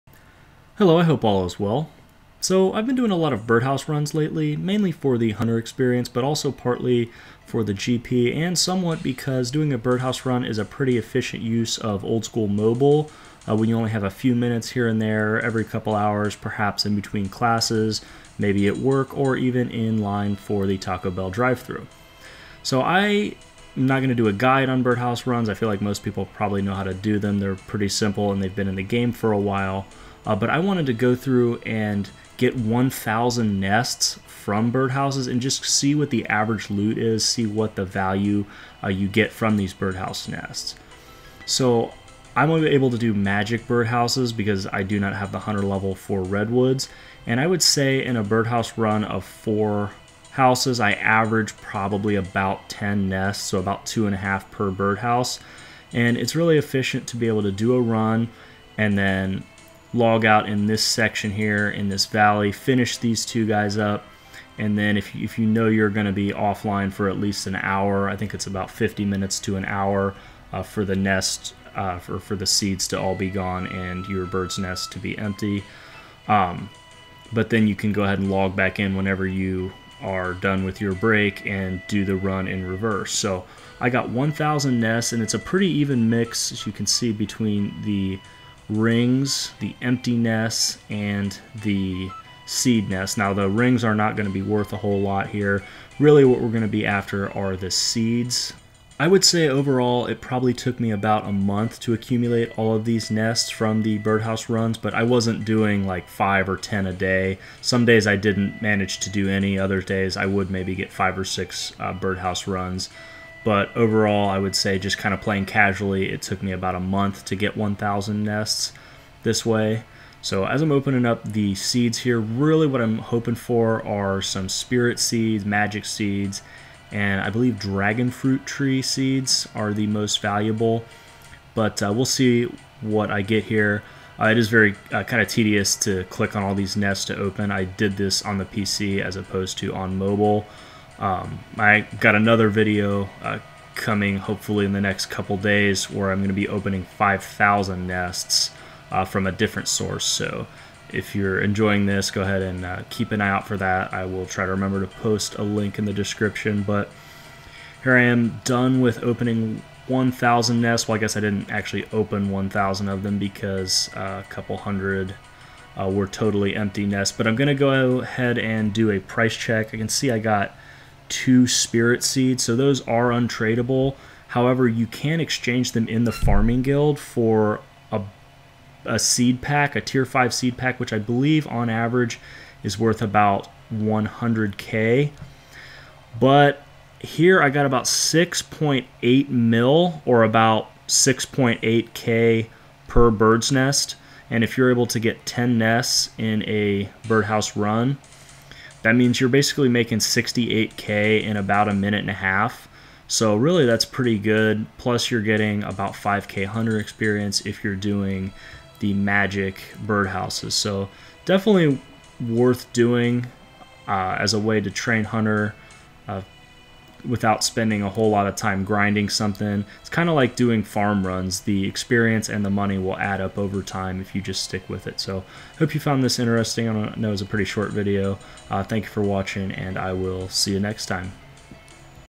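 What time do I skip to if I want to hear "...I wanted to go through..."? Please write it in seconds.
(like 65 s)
30 s.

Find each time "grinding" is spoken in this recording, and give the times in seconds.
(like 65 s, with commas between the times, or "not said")
218 s.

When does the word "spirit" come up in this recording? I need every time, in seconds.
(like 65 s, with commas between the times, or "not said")
124 s, 171 s.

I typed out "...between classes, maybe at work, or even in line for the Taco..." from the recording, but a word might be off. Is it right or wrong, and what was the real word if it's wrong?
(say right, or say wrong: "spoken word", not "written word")
right.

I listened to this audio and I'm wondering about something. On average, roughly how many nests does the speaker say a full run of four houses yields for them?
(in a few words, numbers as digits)
10.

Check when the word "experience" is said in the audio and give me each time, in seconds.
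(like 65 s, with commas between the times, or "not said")
5 s, 206 s, 221 s.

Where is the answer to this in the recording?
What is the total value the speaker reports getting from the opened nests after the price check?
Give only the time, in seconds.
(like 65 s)
187 s.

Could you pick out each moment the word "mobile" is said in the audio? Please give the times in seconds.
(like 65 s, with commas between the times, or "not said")
12 s, 139 s.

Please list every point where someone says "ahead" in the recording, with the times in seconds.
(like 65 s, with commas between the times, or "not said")
78 s, 152 s, 168 s.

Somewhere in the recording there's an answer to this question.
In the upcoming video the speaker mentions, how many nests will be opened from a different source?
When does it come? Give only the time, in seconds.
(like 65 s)
146 s.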